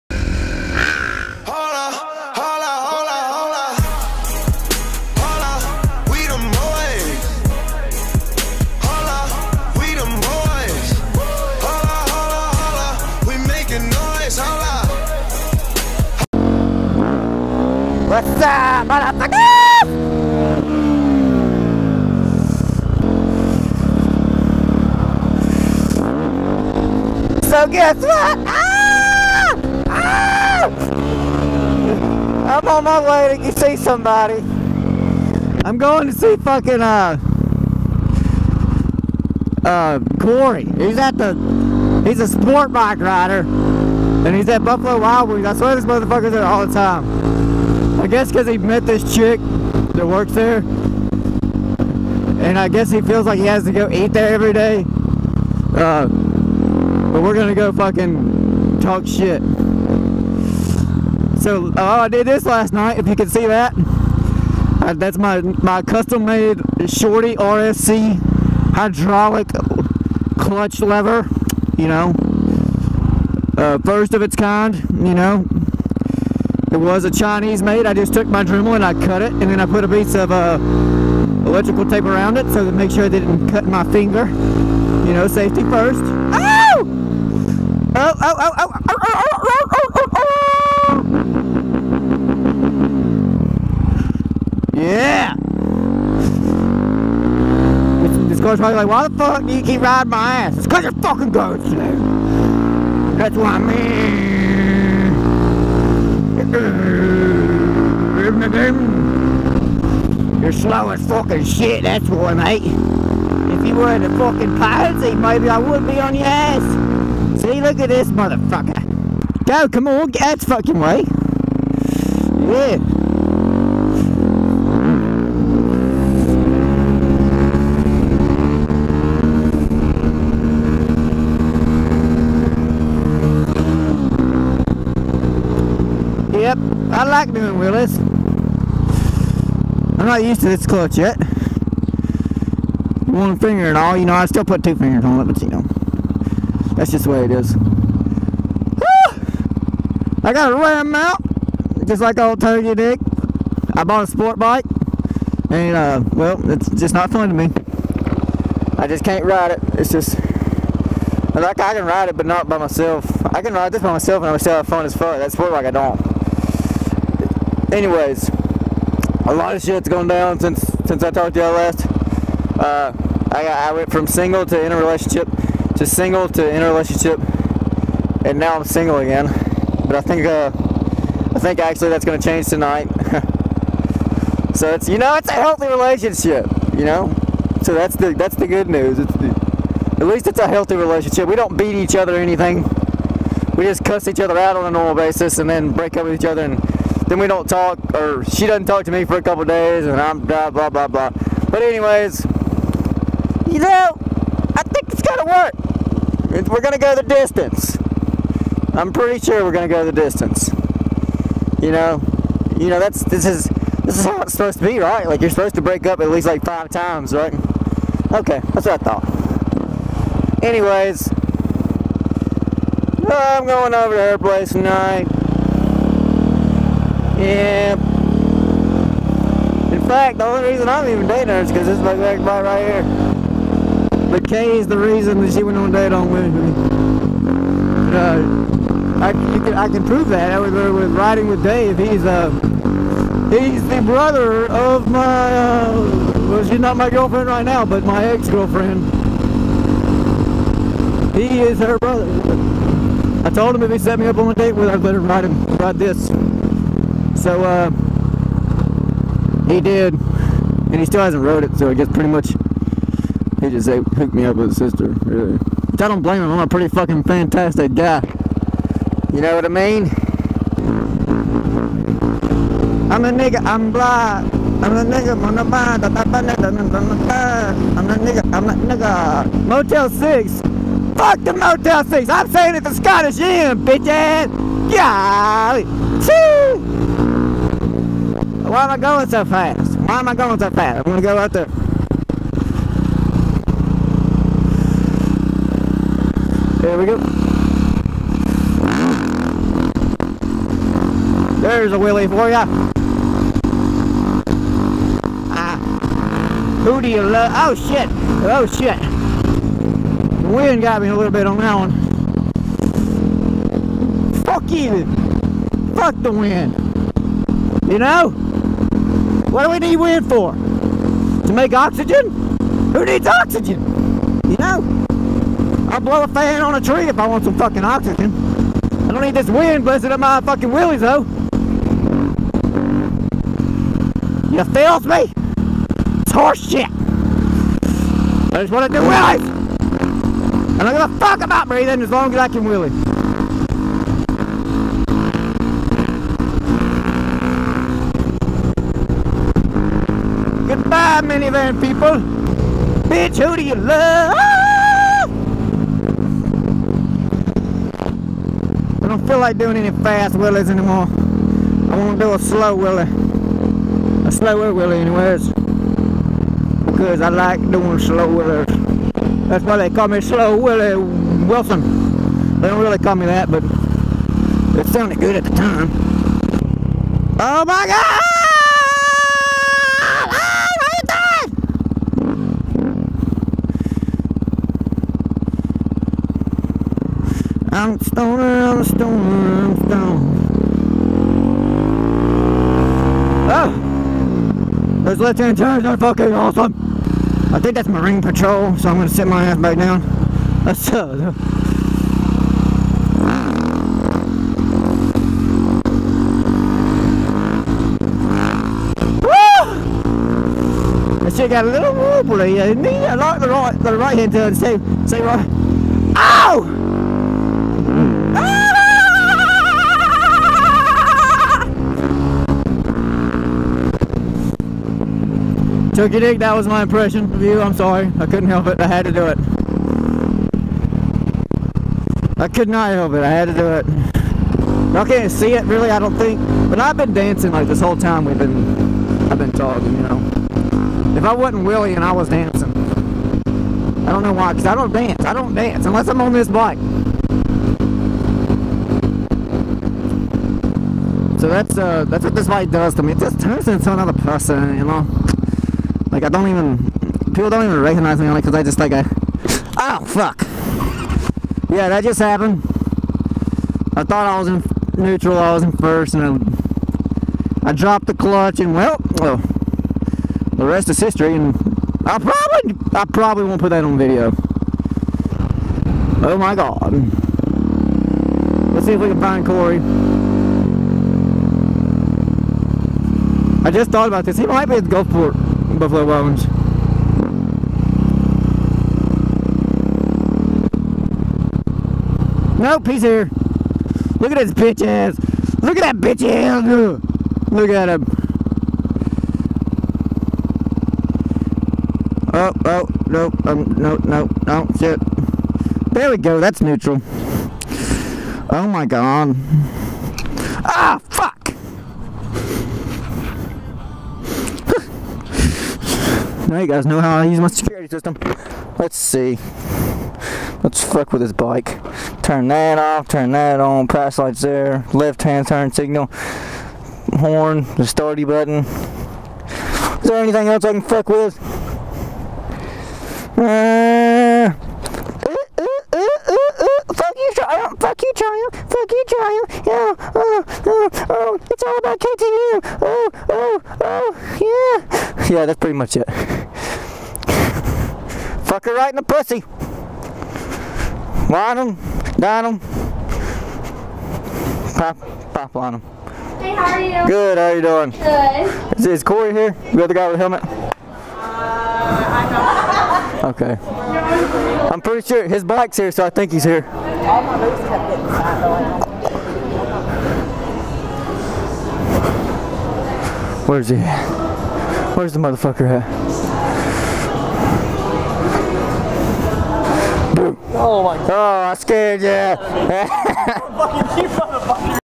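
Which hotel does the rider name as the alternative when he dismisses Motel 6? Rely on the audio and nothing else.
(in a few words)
Scottish Inn.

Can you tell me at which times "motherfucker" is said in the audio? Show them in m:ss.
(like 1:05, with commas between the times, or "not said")
0:45, 1:58, 9:34.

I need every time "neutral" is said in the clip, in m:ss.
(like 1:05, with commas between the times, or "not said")
7:44, 8:26.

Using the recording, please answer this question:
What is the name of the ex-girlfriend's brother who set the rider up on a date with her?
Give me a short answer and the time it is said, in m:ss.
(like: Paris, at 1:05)
Dave, at 4:01.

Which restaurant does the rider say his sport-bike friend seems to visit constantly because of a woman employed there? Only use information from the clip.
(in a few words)
Buffalo Wild Wings.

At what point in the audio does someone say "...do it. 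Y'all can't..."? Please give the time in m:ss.
7:13.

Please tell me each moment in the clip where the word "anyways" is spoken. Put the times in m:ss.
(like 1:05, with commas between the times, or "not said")
2:47, 3:21, 3:40, 6:04.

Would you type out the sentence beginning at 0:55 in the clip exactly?
Uh, but we're gonna go fucking talk shit.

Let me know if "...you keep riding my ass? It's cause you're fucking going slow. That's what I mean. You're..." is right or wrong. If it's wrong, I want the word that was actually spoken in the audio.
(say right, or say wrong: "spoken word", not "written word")
right.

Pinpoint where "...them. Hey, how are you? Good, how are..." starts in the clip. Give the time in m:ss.
9:15.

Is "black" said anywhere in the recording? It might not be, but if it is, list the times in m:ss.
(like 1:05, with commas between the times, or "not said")
3:51, 4:33.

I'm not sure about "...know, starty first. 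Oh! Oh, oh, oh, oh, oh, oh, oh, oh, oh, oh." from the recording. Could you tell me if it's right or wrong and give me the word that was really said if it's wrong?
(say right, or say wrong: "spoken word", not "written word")
wrong: "safety", not "starty".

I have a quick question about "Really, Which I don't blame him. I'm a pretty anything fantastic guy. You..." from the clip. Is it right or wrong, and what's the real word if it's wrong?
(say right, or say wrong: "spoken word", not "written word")
wrong: "fucking", not "anything".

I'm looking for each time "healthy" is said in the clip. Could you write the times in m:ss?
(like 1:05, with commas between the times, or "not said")
3:05, 3:10.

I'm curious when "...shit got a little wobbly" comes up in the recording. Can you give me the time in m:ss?
6:51.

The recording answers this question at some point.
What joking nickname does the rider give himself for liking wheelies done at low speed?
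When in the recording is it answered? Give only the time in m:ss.
6:10.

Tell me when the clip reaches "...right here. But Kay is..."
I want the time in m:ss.
3:52.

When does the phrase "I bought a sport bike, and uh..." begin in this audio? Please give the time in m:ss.
2:33.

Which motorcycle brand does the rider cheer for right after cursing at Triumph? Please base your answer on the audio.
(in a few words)
KTM.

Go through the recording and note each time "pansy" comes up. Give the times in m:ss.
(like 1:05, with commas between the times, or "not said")
1:54.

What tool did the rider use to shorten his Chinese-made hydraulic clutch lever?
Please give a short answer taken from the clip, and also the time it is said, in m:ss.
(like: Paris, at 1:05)
Dremel, at 1:18.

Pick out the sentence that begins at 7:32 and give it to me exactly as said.
It just turns into another person, you know.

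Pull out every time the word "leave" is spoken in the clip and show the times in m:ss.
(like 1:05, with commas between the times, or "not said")
not said.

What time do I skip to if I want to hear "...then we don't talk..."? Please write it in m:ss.
3:17.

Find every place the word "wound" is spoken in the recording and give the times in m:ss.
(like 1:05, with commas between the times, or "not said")
not said.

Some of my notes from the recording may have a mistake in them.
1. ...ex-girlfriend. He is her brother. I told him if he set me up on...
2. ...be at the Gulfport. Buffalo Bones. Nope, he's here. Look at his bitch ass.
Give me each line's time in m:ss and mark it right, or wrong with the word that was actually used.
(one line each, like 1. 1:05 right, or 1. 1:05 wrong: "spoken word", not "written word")
1. 4:08 right
2. 8:04 right.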